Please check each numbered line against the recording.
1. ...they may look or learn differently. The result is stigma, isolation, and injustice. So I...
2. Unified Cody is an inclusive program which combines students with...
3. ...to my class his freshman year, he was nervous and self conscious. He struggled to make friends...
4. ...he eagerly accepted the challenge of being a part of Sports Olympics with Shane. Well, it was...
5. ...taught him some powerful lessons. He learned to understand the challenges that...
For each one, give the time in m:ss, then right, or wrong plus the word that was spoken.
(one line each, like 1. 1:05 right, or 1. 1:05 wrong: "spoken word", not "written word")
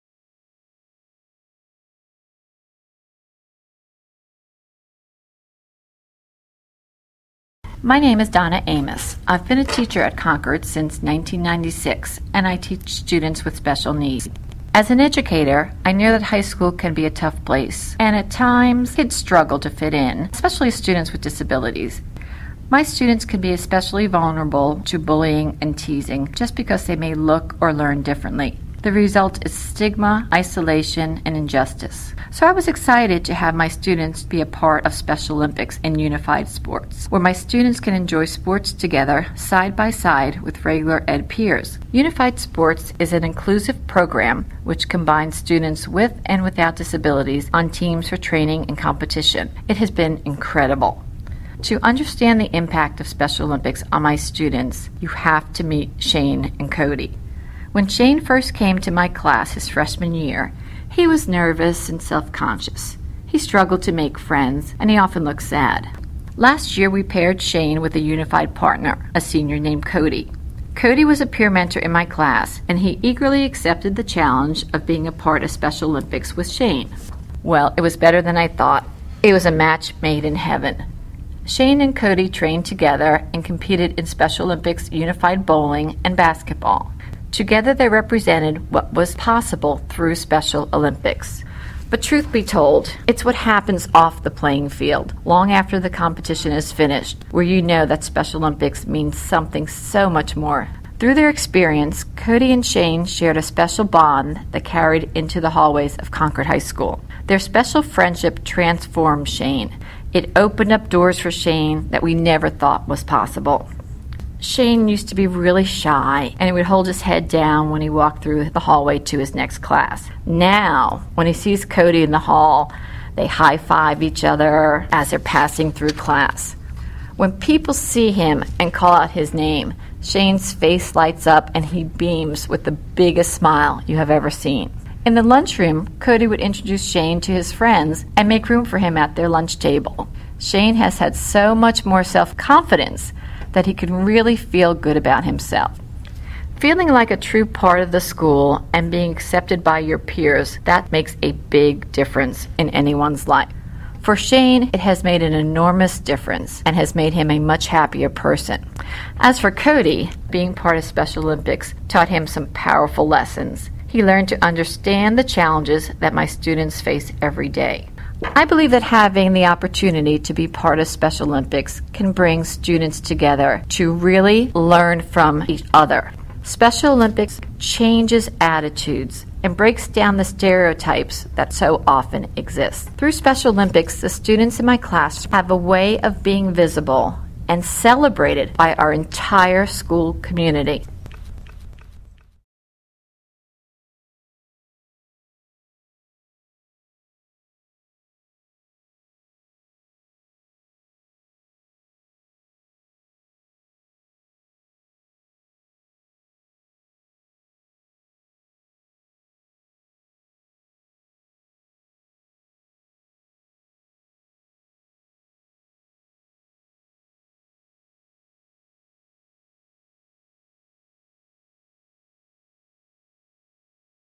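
1. 0:26 right
2. 0:41 wrong: "Sports", not "Cody"
3. 0:58 right
4. 1:12 wrong: "Special", not "Sports"
5. 2:41 right.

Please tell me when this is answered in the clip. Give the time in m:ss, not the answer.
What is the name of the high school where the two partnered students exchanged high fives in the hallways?
1:46.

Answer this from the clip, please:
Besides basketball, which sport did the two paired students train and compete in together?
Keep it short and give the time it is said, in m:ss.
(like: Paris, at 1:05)
Bowling, at 1:25.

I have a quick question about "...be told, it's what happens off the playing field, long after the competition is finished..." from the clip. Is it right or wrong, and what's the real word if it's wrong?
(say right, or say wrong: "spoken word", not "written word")
right.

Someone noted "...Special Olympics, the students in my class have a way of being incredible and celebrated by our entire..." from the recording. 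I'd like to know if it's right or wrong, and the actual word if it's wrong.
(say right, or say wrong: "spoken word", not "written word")
wrong: "visible", not "incredible".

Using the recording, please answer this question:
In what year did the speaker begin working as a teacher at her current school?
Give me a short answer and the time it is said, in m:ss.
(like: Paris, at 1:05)
1996, at 0:11.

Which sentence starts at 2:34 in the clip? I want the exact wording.
For Shane, it has made an enormous difference and has made him a much happier person.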